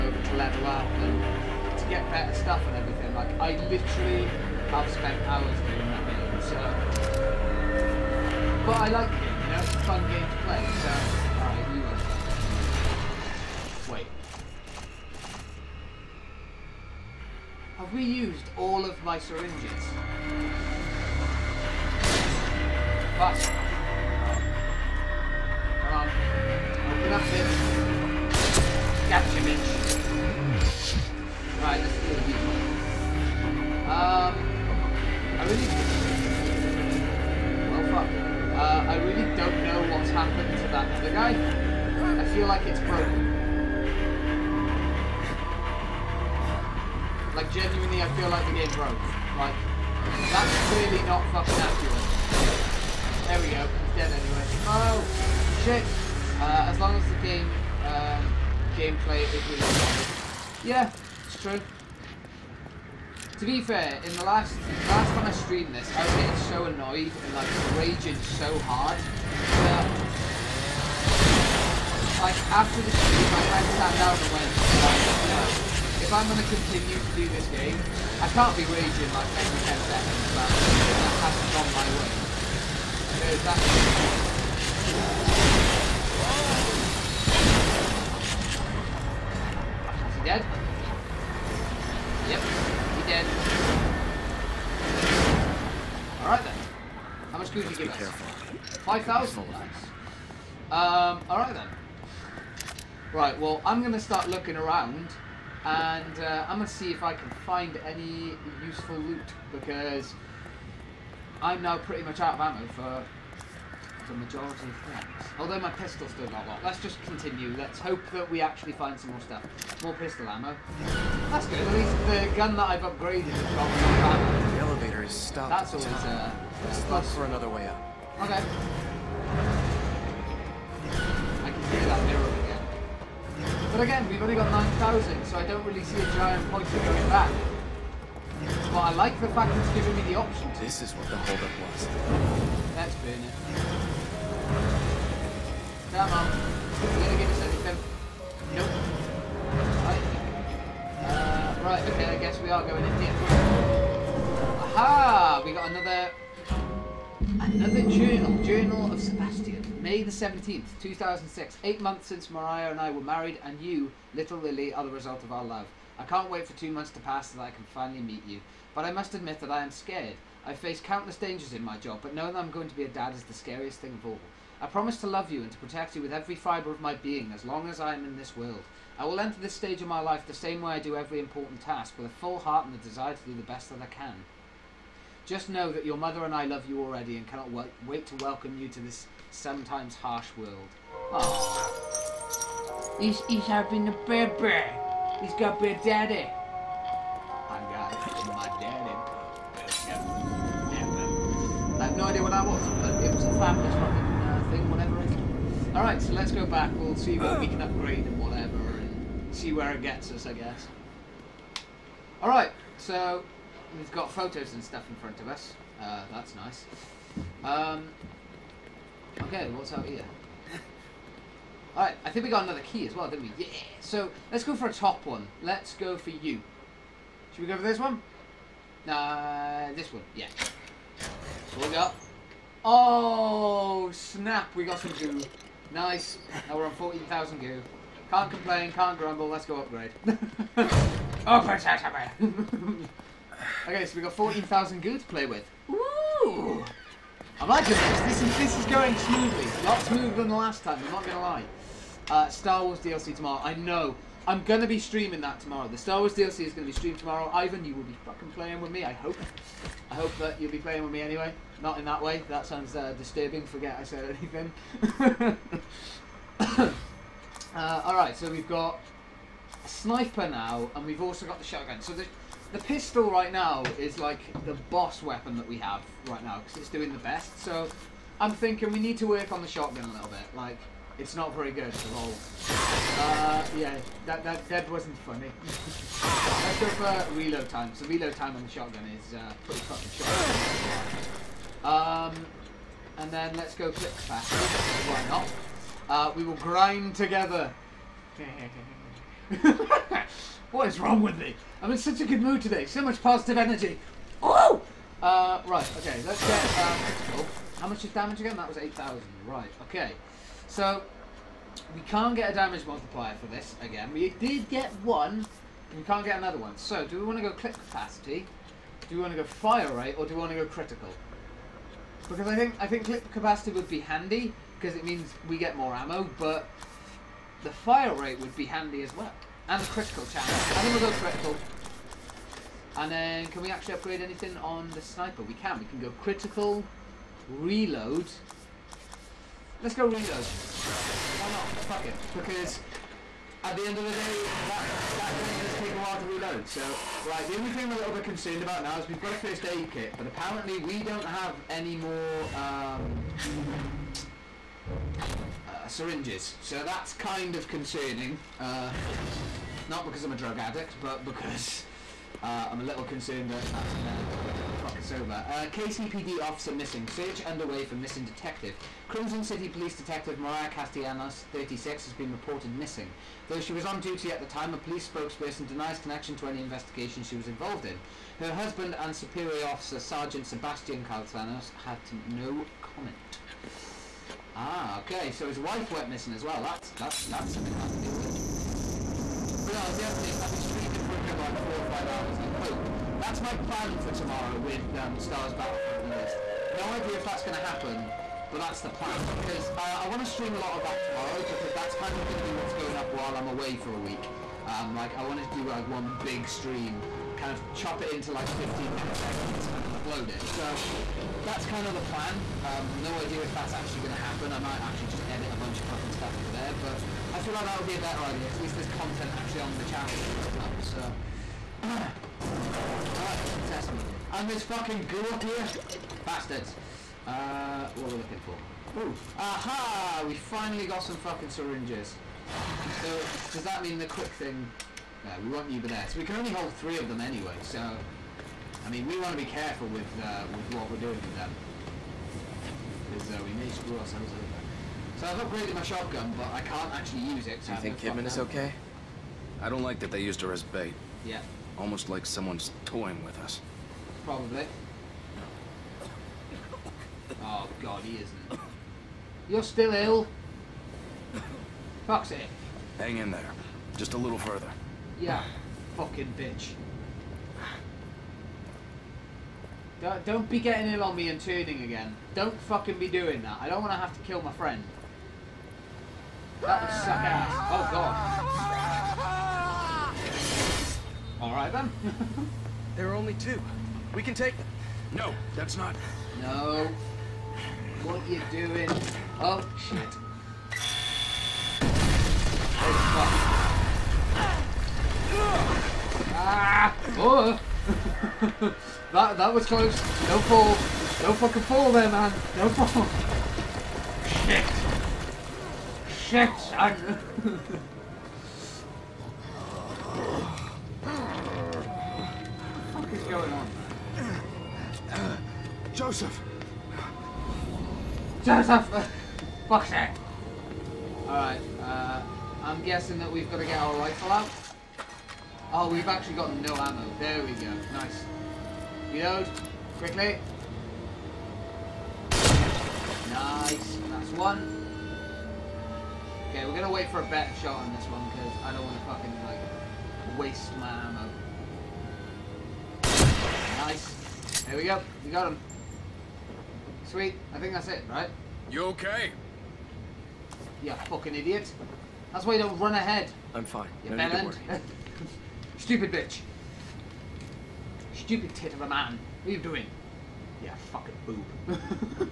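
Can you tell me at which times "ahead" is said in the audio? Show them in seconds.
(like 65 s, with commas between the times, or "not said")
552 s.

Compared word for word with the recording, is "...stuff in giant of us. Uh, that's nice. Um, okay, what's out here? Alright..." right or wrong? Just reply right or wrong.
wrong.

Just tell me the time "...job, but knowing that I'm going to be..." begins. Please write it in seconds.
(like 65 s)
171 s.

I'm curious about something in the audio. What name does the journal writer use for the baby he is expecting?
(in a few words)
Lily.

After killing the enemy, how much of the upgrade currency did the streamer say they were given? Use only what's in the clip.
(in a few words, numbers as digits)
5,000.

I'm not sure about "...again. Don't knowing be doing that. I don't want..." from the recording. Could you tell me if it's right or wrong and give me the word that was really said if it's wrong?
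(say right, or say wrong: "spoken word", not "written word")
wrong: "fucking", not "knowing".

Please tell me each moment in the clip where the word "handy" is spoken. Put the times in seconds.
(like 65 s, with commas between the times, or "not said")
323 s, 328 s.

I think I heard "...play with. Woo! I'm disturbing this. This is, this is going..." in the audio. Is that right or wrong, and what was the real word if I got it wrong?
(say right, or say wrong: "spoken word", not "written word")
wrong: "liking", not "disturbing".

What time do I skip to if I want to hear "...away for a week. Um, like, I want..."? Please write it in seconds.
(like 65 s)
403 s.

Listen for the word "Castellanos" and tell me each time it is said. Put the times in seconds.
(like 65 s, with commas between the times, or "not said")
370 s, 380 s.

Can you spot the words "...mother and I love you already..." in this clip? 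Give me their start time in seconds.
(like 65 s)
185 s.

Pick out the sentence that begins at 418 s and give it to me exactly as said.
at least there's content actually on the channel up.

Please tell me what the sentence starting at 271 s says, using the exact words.
So the, the pistol right now is like the boss weapon that we have right now, because it's doing the best.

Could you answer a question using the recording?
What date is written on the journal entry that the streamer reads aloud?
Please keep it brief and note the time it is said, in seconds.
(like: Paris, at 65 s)
May 17, 2006, at 159 s.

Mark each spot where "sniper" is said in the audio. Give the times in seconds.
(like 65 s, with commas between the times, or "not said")
269 s, 334 s.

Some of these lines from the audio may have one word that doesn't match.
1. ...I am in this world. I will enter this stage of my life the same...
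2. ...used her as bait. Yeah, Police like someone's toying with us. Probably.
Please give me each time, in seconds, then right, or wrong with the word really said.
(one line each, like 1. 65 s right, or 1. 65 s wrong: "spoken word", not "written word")
1. 177 s right
2. 450 s wrong: "Almost", not "Police".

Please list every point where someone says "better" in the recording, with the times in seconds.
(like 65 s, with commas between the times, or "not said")
2 s, 417 s, 537 s.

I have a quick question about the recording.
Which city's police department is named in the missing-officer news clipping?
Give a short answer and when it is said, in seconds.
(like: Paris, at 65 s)
Krimson City, at 368 s.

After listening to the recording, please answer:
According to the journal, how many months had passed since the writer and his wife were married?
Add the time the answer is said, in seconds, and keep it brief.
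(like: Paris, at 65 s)
8, at 161 s.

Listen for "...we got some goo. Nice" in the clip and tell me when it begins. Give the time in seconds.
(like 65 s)
234 s.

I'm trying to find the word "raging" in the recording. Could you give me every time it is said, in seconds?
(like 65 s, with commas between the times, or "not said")
67 s, 78 s.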